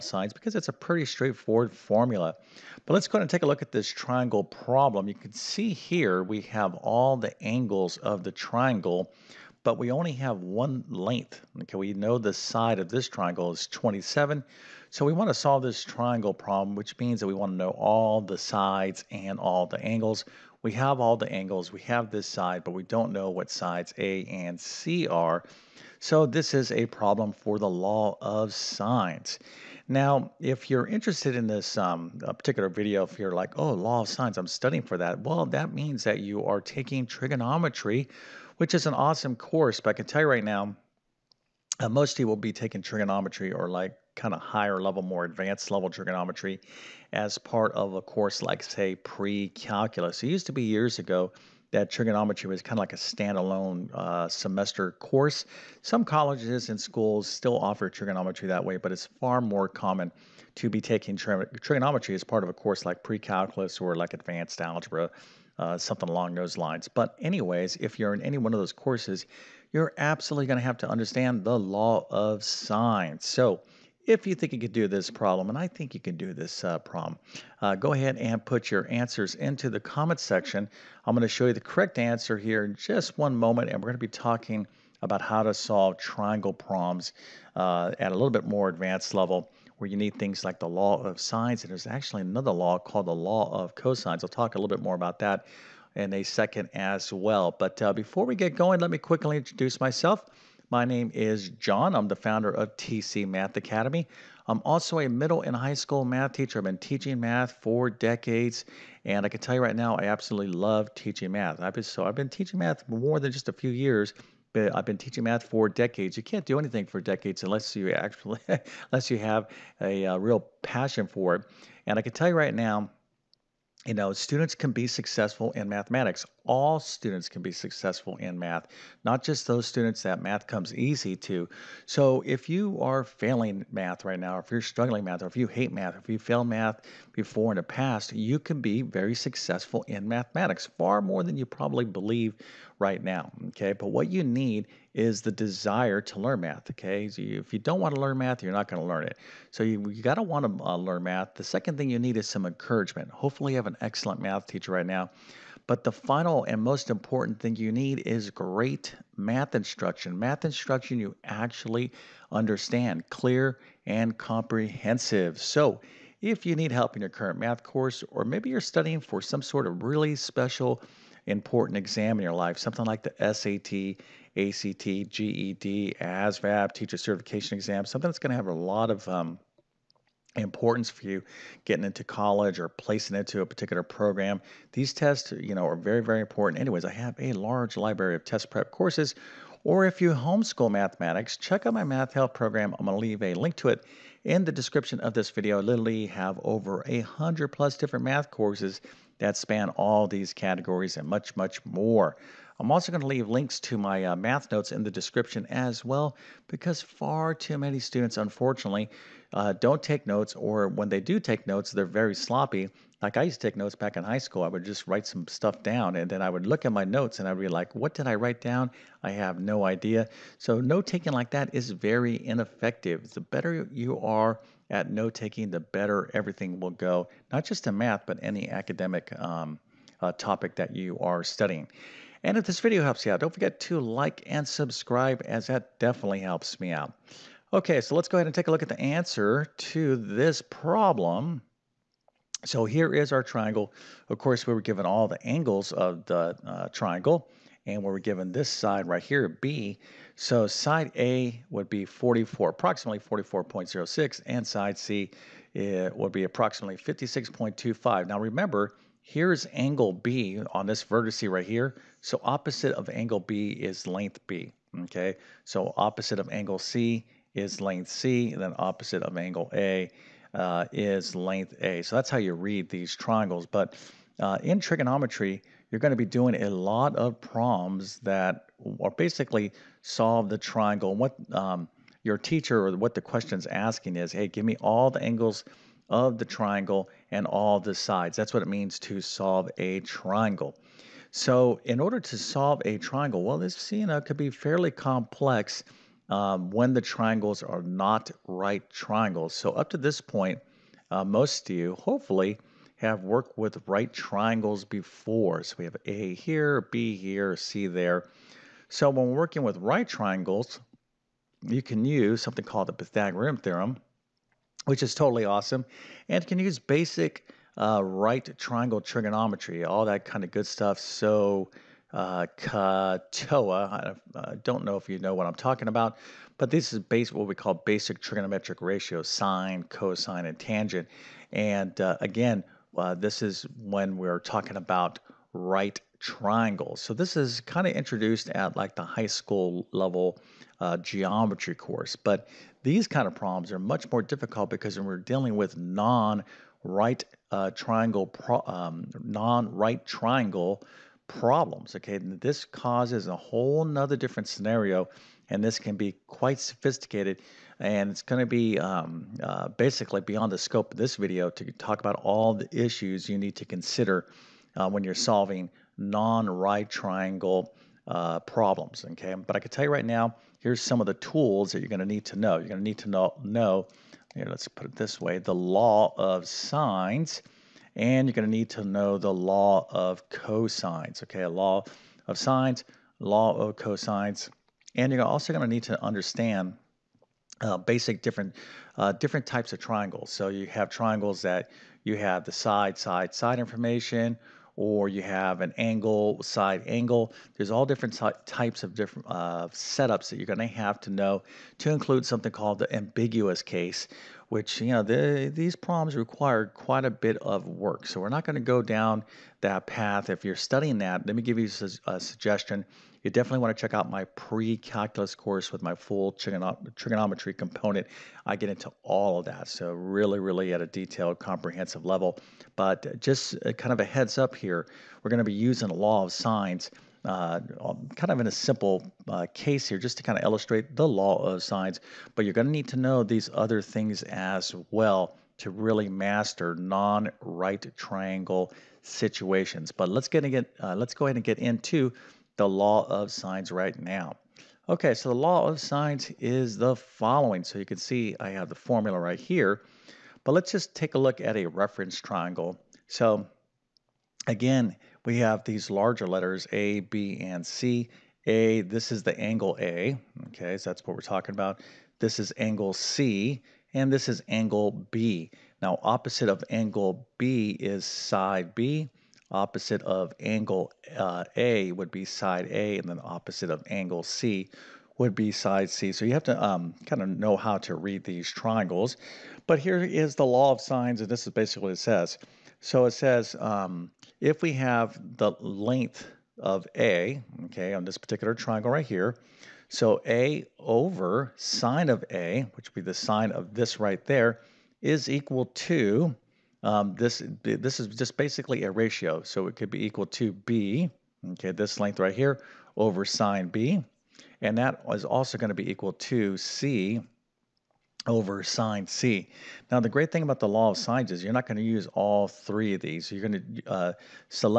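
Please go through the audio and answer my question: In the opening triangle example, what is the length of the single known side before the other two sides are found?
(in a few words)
27.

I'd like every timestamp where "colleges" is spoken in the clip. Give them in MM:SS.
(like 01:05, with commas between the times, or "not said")
00:56, 03:02.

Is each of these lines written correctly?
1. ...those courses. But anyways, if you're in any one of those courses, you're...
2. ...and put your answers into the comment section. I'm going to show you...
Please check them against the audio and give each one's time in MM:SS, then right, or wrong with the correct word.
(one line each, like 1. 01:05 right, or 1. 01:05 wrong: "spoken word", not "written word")
1. 01:06 wrong: "lines", not "courses"
2. 01:18 right.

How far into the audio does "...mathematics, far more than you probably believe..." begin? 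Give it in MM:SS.
02:20.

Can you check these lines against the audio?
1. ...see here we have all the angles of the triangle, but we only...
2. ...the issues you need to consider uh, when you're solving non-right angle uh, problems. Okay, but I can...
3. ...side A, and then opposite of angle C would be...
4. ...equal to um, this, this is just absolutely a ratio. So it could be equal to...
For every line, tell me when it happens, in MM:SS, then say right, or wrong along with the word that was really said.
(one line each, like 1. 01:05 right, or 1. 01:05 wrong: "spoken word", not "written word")
1. 00:05 right
2. 06:02 wrong: "triangle", not "angle"
3. 07:52 right
4. 08:15 wrong: "basically", not "absolutely".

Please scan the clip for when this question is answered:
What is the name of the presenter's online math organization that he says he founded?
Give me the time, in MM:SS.
01:42.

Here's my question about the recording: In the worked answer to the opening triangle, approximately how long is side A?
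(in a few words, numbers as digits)
44.06.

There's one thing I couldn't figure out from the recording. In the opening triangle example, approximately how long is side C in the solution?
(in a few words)
56.25.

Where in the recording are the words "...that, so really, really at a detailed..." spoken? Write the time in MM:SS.
06:59.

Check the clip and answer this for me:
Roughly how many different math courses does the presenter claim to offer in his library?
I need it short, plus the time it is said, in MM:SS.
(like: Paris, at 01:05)
over a hundred, at 03:16.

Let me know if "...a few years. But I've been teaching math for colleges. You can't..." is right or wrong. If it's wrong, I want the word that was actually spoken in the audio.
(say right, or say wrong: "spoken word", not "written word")
wrong: "decades", not "colleges".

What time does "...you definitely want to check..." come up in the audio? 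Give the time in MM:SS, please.
06:53.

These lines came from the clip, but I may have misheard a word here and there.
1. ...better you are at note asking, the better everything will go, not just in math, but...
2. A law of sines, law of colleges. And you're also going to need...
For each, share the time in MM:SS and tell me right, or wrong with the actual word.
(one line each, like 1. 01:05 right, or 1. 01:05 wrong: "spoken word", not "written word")
1. 03:43 wrong: "taking", not "asking"
2. 06:21 wrong: "cosines", not "colleges".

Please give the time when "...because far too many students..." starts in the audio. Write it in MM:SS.
03:26.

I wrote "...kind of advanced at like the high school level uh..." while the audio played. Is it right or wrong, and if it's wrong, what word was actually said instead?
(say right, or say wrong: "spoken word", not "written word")
wrong: "introduced", not "advanced".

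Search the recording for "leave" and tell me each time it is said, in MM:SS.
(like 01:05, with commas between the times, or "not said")
03:13, 03:23.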